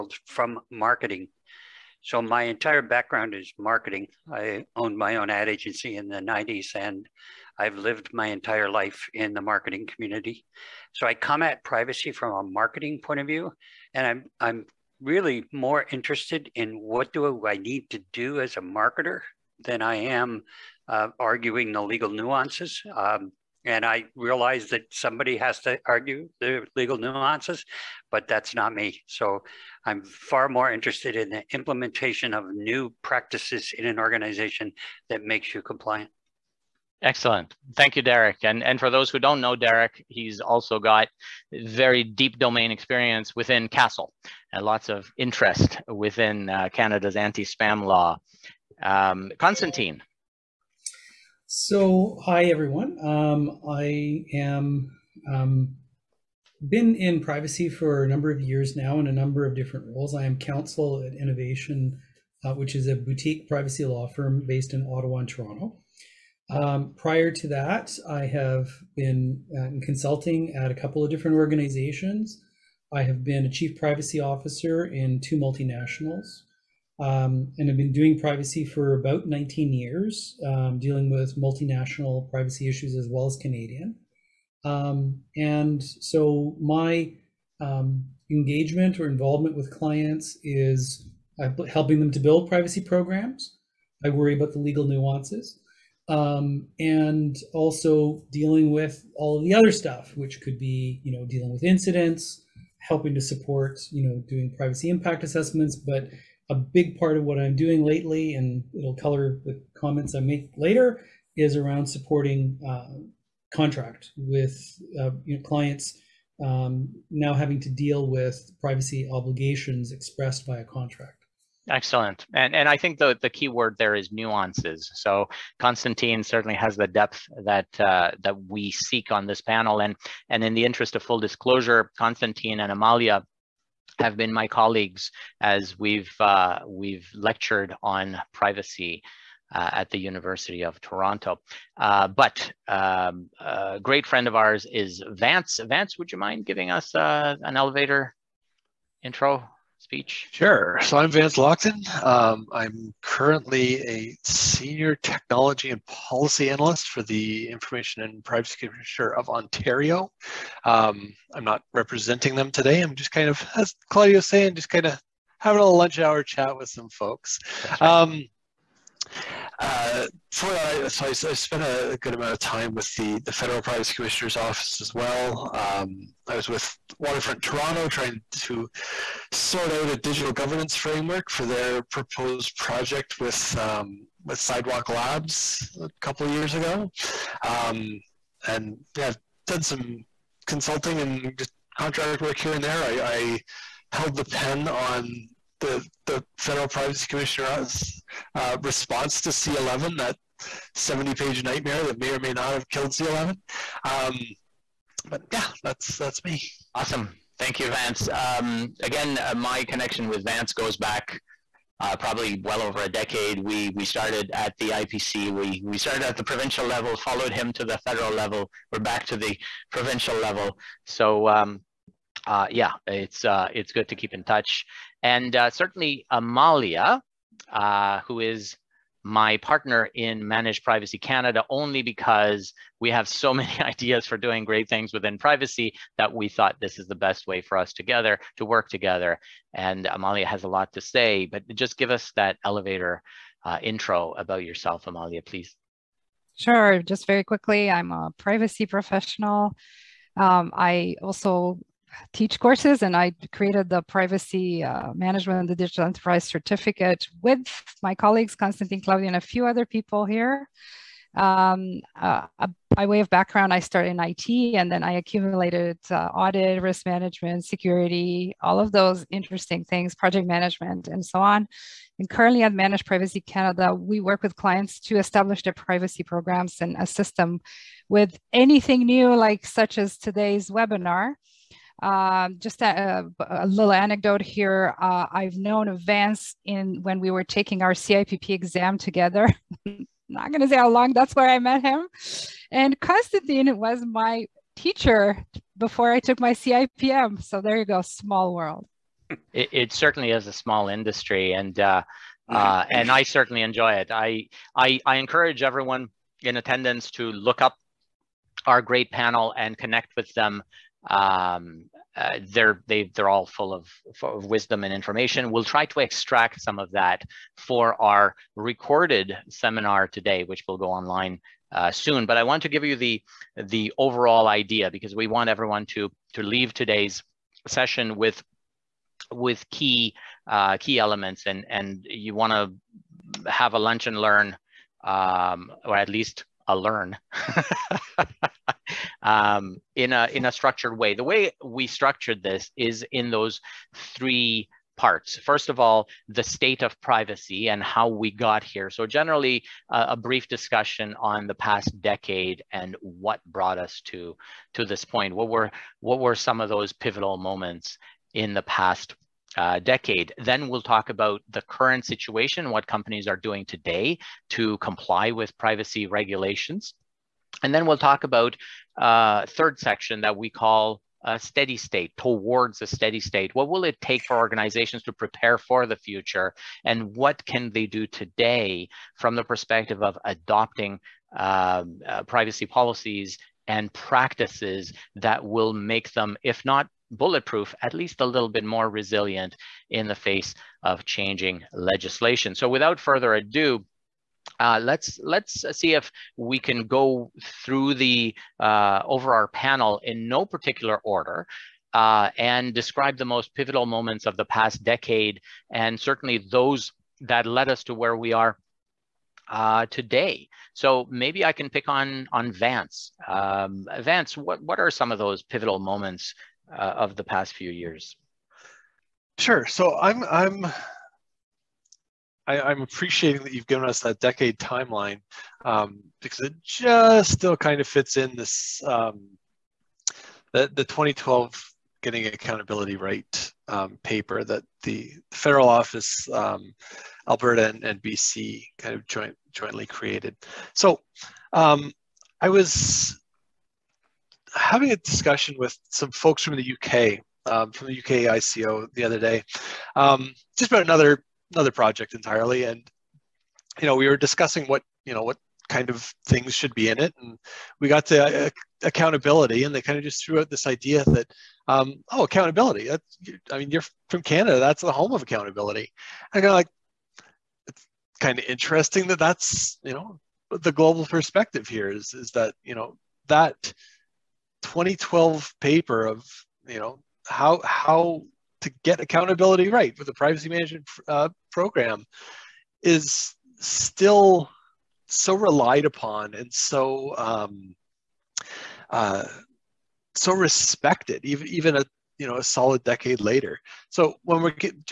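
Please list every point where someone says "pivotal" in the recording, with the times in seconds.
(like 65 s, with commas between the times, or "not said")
356 s, 403 s, 415 s.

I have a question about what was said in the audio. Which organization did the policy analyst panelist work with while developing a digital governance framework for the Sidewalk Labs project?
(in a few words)
Waterfront Toronto.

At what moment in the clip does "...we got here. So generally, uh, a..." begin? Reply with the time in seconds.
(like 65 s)
347 s.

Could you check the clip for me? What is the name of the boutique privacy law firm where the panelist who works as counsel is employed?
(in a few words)
nNovation.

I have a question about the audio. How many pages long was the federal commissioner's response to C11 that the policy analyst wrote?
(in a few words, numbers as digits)
70.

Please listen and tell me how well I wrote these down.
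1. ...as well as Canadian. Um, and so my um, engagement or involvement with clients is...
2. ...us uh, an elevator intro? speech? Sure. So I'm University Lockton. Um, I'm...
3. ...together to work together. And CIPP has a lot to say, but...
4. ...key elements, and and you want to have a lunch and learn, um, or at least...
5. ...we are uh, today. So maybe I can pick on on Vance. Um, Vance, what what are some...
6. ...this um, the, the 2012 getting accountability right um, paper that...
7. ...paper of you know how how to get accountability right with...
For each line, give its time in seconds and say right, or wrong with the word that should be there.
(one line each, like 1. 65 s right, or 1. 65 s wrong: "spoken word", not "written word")
1. 82 s right
2. 146 s wrong: "Vance", not "University"
3. 237 s wrong: "Amalia", not "CIPP"
4. 330 s right
5. 407 s right
6. 428 s right
7. 475 s right.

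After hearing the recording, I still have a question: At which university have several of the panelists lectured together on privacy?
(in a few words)
University of Toronto.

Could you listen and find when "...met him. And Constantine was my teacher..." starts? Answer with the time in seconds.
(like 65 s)
291 s.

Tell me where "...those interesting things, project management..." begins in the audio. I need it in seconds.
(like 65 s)
268 s.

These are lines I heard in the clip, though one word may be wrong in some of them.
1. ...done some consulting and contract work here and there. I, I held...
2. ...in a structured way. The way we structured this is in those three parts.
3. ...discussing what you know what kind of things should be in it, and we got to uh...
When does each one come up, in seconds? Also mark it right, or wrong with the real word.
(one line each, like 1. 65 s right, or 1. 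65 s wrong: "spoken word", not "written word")
1. 189 s right
2. 340 s right
3. 453 s right.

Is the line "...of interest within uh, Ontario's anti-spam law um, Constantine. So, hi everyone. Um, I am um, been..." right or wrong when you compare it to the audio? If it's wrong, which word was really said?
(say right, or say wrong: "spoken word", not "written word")
wrong: "Canada", not "Ontario".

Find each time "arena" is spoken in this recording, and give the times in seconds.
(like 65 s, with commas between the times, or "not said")
not said.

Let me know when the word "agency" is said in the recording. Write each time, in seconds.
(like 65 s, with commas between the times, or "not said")
5 s.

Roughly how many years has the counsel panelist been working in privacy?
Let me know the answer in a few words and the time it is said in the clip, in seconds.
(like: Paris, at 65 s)
19, at 79 s.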